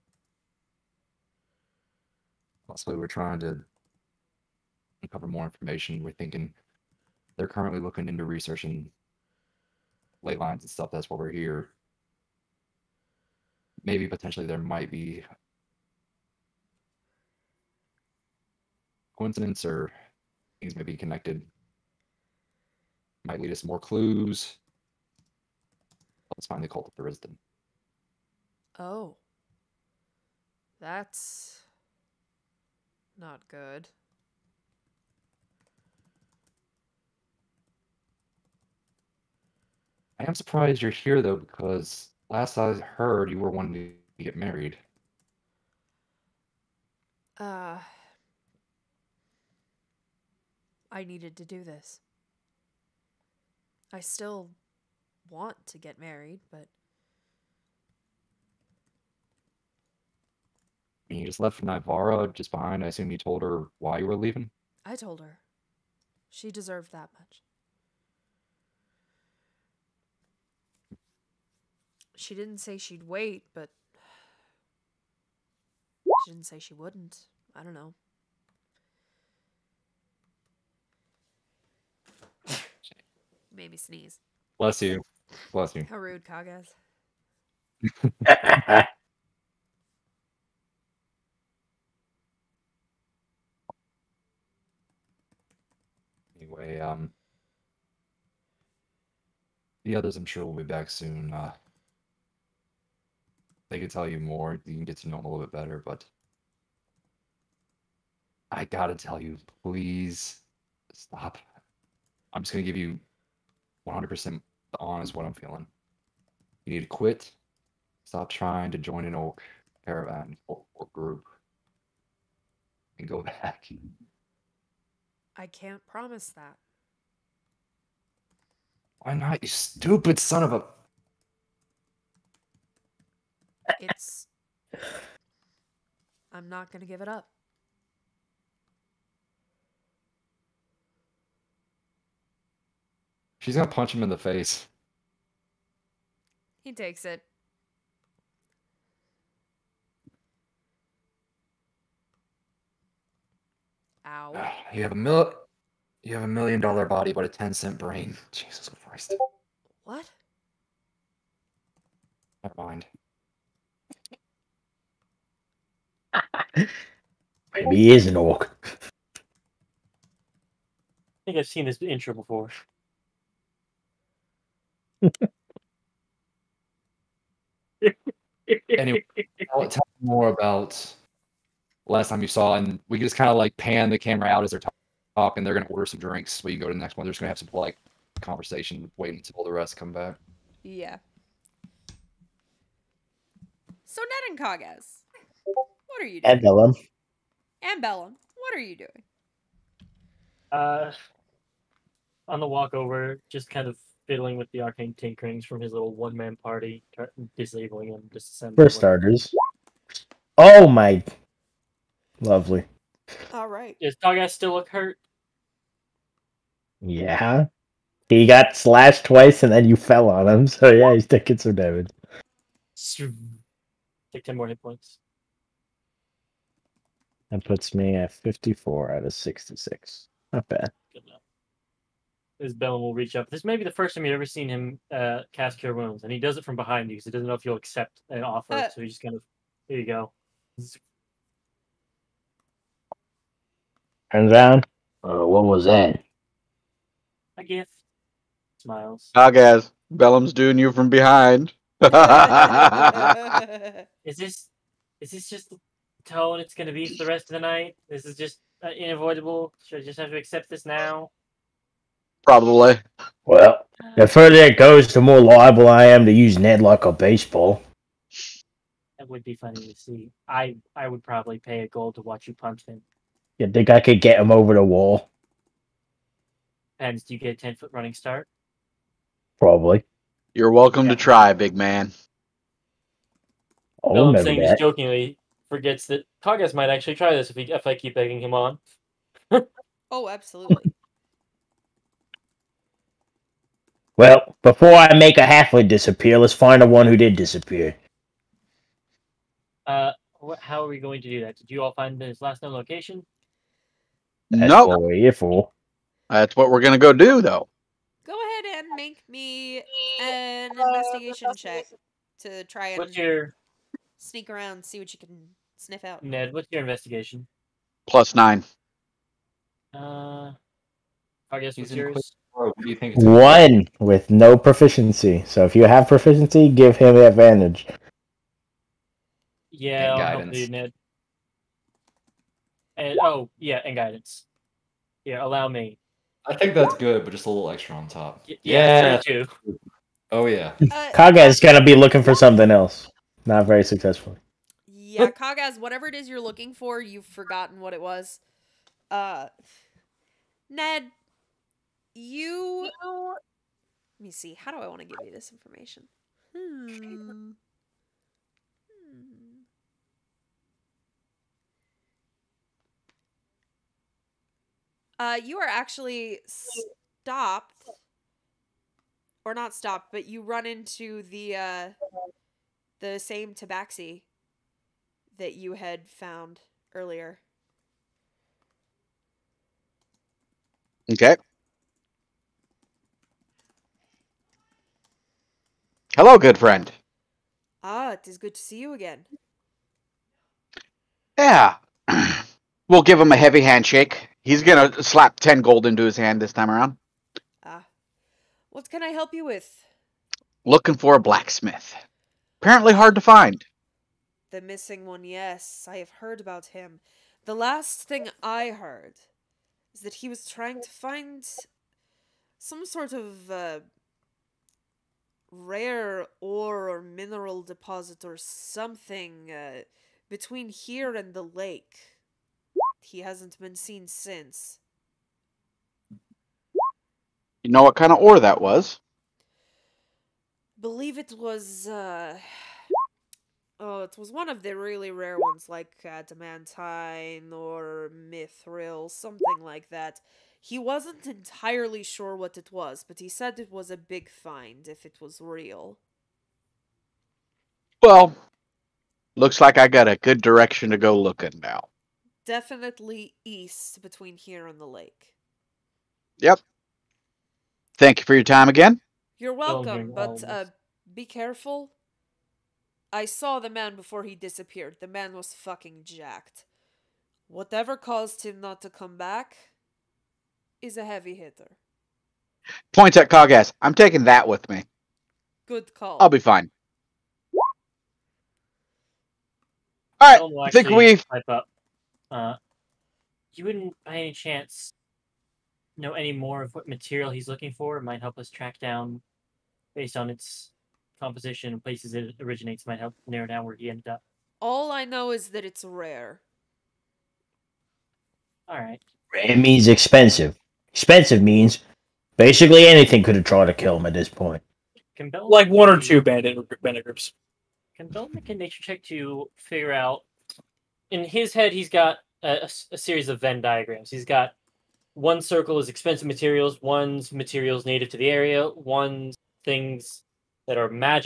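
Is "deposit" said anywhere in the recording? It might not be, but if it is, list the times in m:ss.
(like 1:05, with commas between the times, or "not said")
6:57.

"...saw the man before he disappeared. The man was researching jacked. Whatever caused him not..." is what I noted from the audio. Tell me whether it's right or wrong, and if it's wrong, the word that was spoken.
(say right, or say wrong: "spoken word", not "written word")
wrong: "fucking", not "researching".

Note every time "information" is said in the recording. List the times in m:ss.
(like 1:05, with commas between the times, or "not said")
0:05, 5:55.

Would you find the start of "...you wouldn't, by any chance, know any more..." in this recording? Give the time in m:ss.
8:03.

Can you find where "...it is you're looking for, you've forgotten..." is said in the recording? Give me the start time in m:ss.
5:45.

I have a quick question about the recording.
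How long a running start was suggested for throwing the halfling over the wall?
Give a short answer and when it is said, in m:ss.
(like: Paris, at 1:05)
10 feet, at 4:37.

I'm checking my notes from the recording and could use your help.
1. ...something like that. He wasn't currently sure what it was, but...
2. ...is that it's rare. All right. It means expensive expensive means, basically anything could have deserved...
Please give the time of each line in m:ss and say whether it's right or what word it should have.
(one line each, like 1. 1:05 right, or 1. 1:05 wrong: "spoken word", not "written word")
1. 7:18 wrong: "entirely", not "currently"
2. 8:15 wrong: "tried", not "deserved".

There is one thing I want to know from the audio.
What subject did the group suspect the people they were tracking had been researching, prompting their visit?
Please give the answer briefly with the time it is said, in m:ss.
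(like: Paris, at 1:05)
Ley lines, at 0:10.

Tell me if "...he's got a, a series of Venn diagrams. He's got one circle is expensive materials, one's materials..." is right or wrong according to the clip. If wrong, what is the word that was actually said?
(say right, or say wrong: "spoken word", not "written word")
right.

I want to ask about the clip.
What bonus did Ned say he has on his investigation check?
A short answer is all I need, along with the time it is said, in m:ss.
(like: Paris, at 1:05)
Plus 9, at 5:17.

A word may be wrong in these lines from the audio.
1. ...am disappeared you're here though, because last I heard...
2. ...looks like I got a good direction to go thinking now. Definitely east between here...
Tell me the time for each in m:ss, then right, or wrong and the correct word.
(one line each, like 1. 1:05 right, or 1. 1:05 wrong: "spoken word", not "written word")
1. 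0:40 wrong: "surprised", not "disappeared"
2. 7:29 wrong: "looking", not "thinking".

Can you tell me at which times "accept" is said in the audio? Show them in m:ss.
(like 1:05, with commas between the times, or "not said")
3:57, 4:20.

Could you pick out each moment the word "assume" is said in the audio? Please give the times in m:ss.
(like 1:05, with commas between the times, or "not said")
1:02.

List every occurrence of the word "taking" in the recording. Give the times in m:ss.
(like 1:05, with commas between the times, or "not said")
3:41, 7:53.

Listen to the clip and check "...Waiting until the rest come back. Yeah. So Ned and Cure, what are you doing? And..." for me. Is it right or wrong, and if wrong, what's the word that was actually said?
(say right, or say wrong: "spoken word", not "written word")
wrong: "Kagaz", not "Cure".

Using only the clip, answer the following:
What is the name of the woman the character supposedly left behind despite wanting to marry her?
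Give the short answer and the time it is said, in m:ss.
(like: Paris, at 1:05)
Naivara, at 1:01.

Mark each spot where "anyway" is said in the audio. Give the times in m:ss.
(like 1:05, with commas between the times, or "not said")
1:36, 2:58.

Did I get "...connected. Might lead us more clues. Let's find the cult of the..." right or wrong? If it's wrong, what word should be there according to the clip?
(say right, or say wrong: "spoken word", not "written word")
right.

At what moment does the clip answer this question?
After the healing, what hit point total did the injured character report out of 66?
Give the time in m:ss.
3:48.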